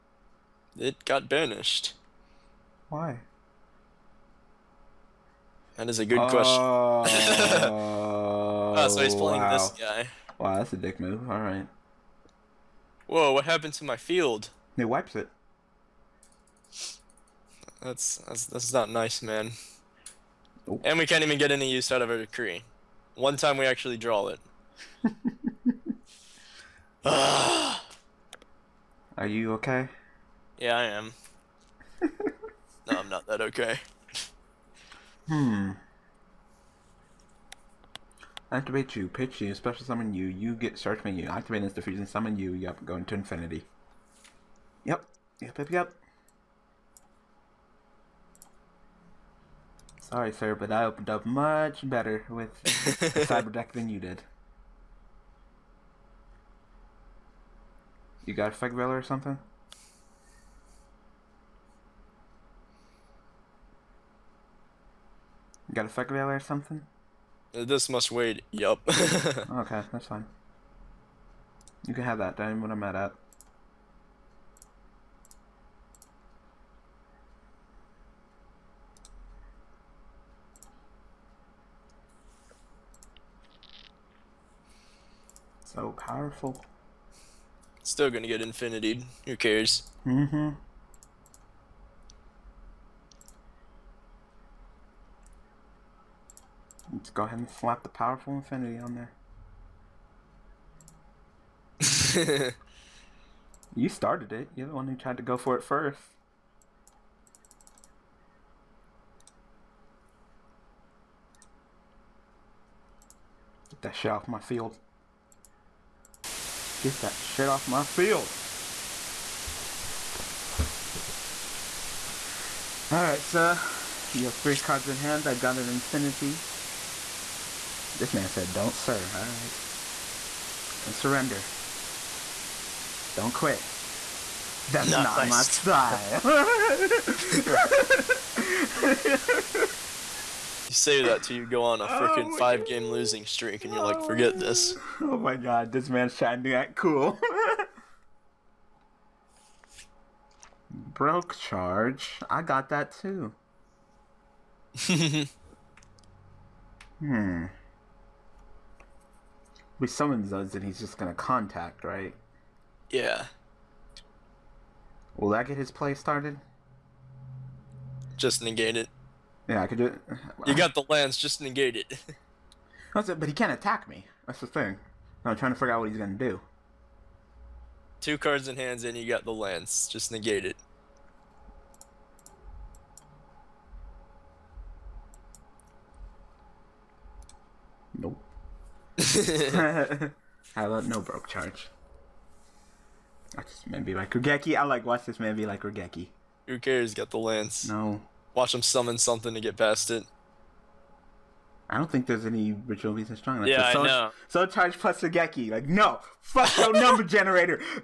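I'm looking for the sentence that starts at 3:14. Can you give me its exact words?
I like watch this maybe like Raigeki.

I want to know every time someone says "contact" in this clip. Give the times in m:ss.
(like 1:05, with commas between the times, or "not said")
2:41.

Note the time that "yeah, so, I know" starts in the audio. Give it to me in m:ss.
3:23.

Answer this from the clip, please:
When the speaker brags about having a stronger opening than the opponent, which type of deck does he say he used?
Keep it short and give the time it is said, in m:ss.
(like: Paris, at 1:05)
Cyber deck, at 0:52.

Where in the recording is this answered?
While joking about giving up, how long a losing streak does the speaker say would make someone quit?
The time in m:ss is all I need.
2:22.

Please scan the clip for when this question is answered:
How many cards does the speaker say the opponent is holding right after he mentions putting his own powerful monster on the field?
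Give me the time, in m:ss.
2:04.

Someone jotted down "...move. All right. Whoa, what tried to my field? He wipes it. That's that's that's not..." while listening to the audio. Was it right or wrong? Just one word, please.
wrong.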